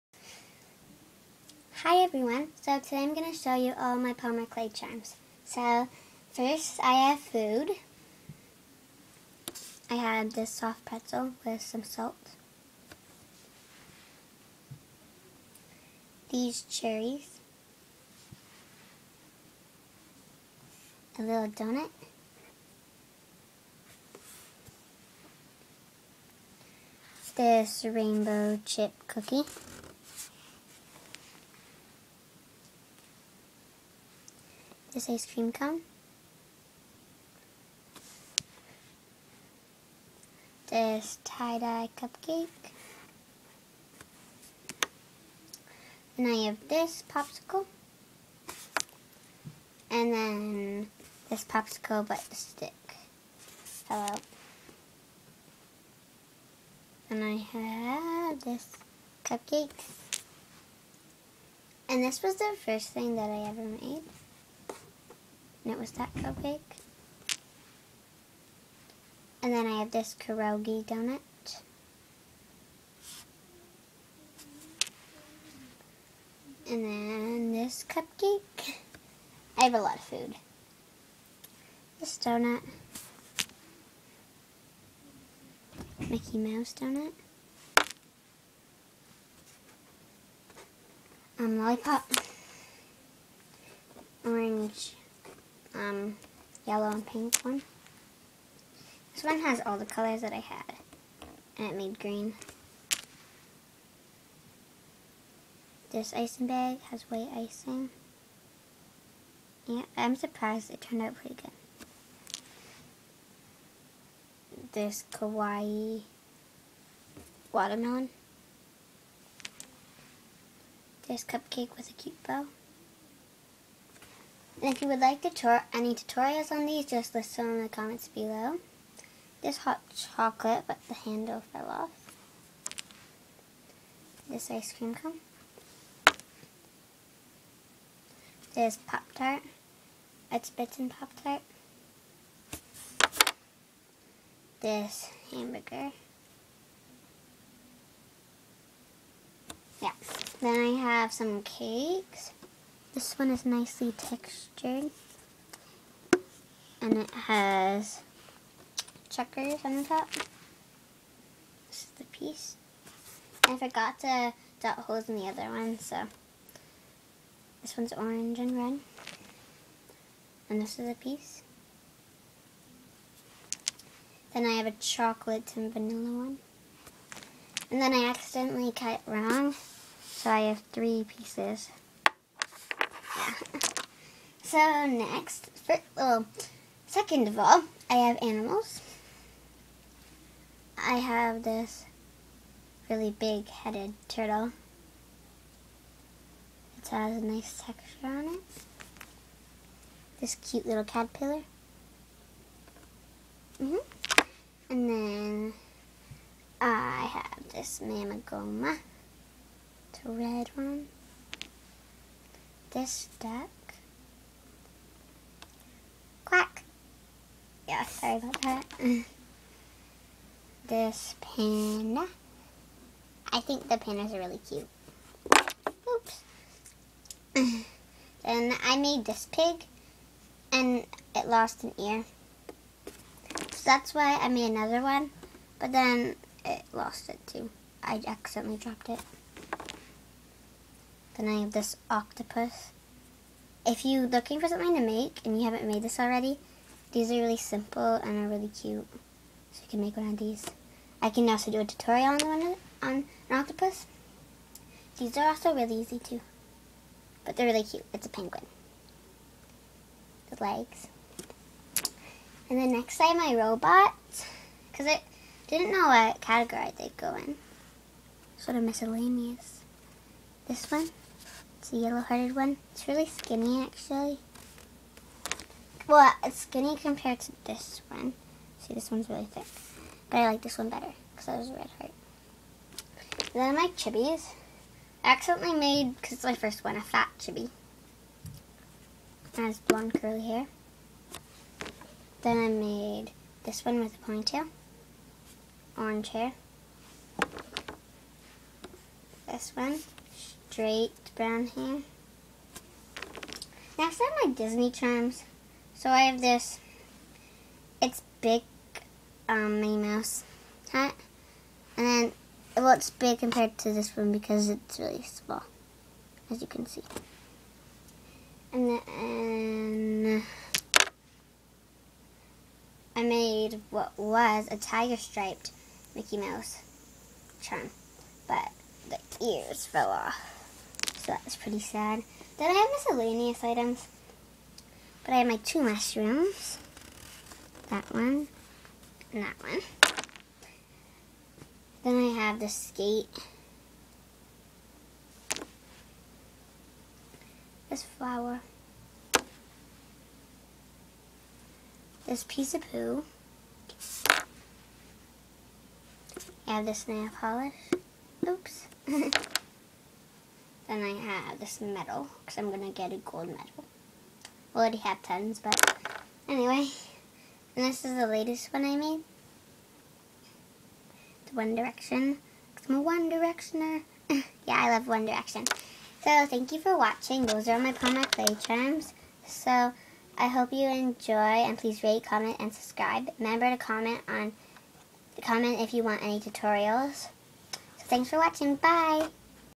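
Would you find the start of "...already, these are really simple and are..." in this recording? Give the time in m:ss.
4:05.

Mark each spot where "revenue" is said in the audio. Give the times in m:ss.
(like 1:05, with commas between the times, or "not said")
not said.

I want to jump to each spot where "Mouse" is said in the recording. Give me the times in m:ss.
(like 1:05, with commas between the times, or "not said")
1:26, 5:09, 5:26.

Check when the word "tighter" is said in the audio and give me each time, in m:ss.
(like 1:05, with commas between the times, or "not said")
not said.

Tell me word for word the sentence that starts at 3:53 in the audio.
So that's why I made another one.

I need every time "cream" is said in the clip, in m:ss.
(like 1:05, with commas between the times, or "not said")
0:35, 2:14.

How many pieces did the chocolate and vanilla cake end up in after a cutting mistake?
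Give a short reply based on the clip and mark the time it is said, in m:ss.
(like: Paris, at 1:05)
3, at 3:00.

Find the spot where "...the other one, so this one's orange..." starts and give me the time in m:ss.
2:45.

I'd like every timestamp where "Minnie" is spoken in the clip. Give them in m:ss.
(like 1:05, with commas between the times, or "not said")
5:09.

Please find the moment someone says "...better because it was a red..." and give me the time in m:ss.
4:40.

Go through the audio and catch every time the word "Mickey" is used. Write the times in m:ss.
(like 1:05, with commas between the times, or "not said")
1:26, 5:25.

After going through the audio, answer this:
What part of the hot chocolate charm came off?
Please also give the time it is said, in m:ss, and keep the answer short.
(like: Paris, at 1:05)
The handle, at 2:10.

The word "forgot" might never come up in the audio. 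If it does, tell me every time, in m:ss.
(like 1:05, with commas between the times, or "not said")
2:43.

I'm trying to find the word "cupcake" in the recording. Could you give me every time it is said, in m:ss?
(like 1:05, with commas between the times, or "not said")
0:41, 0:59, 1:06, 1:17, 2:01.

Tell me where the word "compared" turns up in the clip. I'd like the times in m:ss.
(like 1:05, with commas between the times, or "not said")
4:36, 5:13.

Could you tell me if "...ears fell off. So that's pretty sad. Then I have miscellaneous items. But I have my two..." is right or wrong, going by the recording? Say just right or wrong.
right.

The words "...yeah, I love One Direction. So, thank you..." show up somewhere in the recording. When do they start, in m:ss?
6:14.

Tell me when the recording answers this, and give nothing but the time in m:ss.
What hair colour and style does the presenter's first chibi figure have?
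4:49.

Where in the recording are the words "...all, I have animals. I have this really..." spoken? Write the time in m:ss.
3:07.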